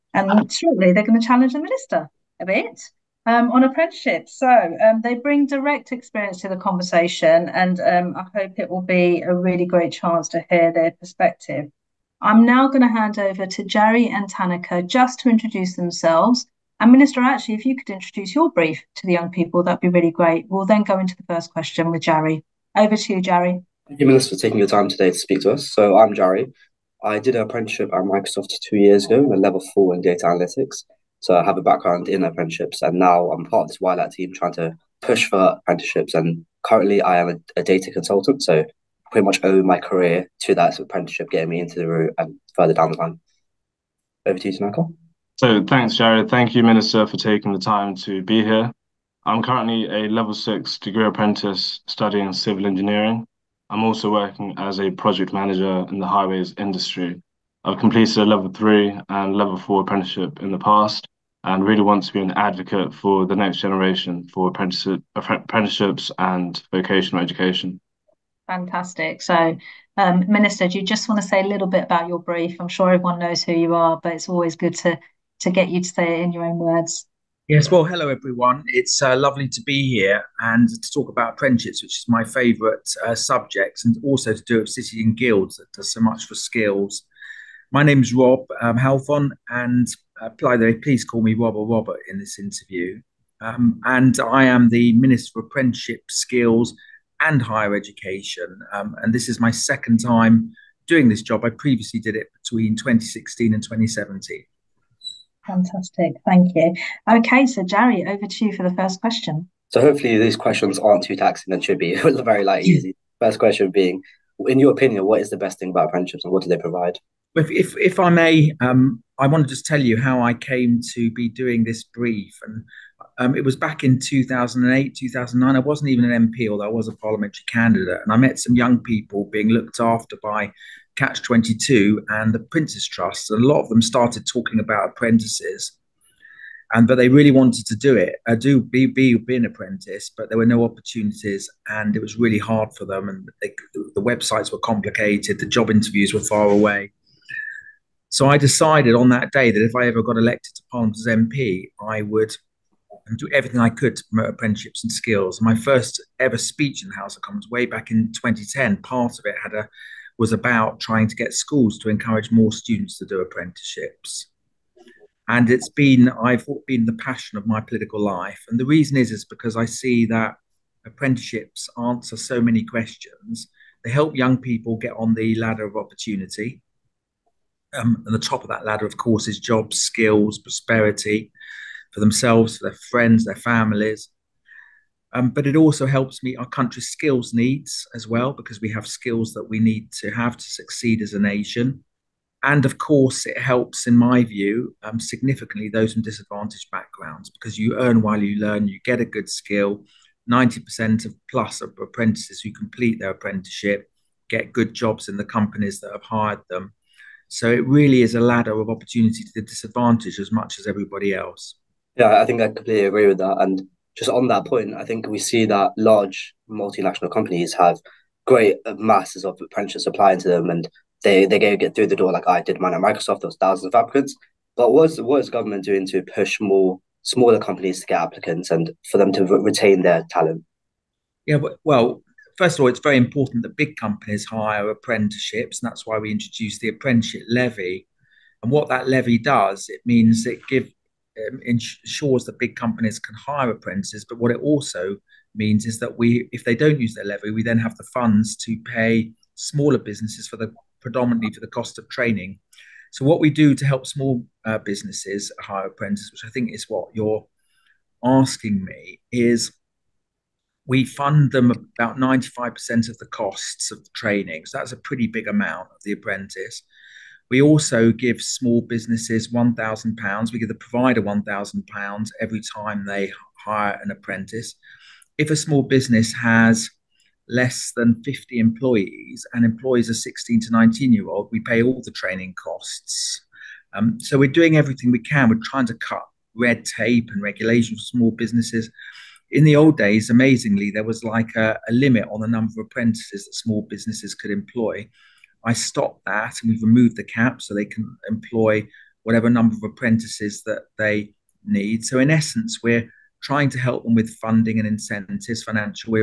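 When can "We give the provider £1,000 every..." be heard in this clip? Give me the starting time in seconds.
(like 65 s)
270 s.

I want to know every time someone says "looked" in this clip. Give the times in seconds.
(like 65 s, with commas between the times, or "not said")
129 s.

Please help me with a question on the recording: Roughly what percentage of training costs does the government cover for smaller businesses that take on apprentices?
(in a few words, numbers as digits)
95%.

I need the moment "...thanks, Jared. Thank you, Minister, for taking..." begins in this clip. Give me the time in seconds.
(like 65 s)
45 s.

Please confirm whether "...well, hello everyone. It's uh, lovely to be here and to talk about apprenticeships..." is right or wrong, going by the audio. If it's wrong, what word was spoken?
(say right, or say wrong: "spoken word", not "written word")
right.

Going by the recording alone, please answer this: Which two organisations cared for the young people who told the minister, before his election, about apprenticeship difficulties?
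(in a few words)
Catch 22 and the Prince's Trust.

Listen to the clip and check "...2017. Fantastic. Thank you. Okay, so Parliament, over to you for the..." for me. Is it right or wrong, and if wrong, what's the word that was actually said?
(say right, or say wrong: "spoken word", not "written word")
wrong: "Jerry", not "Parliament".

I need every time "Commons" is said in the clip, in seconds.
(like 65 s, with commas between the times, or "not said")
157 s.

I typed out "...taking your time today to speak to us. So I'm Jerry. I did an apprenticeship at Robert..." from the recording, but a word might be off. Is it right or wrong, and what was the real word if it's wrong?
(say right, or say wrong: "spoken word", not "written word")
wrong: "Microsoft", not "Robert".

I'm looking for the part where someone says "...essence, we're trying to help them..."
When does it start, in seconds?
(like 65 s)
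302 s.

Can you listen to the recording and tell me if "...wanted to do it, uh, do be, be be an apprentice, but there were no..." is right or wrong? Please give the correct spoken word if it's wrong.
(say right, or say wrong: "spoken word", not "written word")
right.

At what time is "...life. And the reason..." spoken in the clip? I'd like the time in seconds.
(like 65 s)
167 s.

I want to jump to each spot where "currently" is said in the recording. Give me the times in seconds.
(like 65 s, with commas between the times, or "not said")
36 s, 49 s.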